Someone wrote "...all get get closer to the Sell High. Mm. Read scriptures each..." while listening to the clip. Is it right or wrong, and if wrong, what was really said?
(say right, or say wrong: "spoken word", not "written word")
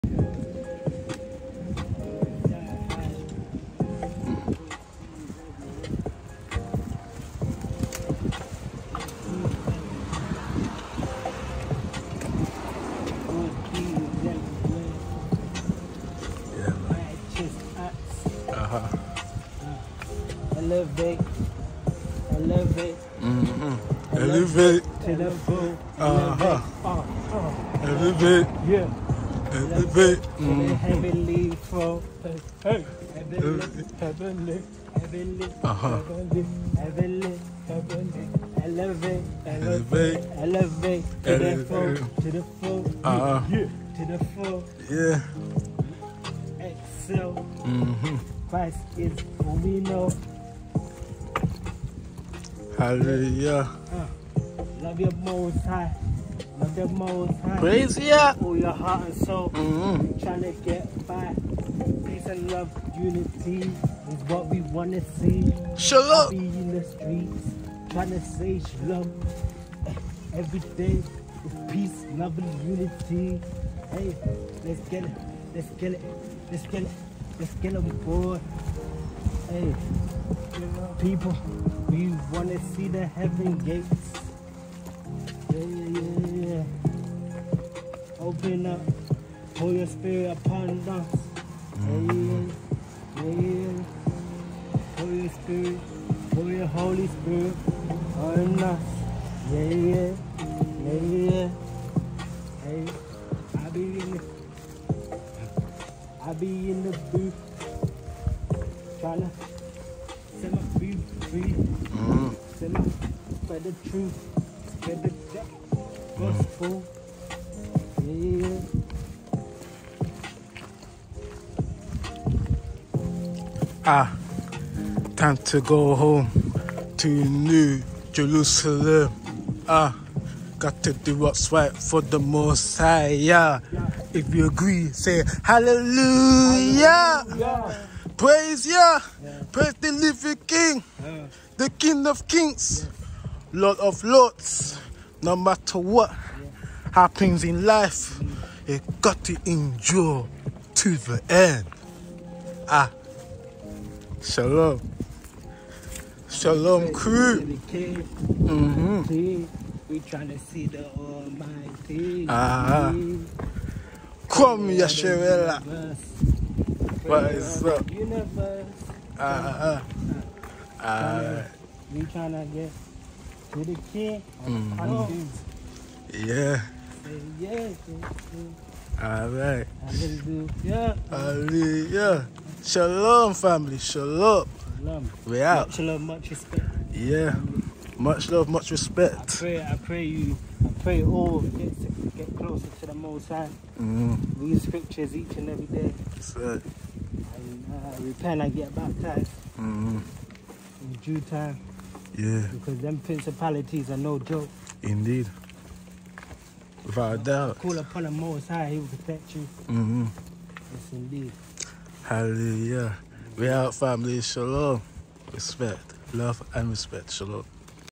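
wrong: "Most", not "Sell".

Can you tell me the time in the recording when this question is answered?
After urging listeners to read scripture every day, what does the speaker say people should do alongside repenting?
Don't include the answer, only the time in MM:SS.
03:18.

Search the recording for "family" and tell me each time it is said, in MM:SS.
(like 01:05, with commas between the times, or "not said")
03:03, 03:33.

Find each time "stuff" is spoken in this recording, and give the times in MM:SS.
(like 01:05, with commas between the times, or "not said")
not said.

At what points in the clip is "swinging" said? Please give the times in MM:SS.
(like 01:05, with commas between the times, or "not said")
not said.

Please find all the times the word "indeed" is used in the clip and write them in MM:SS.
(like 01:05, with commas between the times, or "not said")
03:24, 03:30.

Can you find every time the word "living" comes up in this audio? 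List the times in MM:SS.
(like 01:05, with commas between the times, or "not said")
02:19.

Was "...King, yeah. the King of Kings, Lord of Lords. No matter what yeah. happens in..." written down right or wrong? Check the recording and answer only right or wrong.
right.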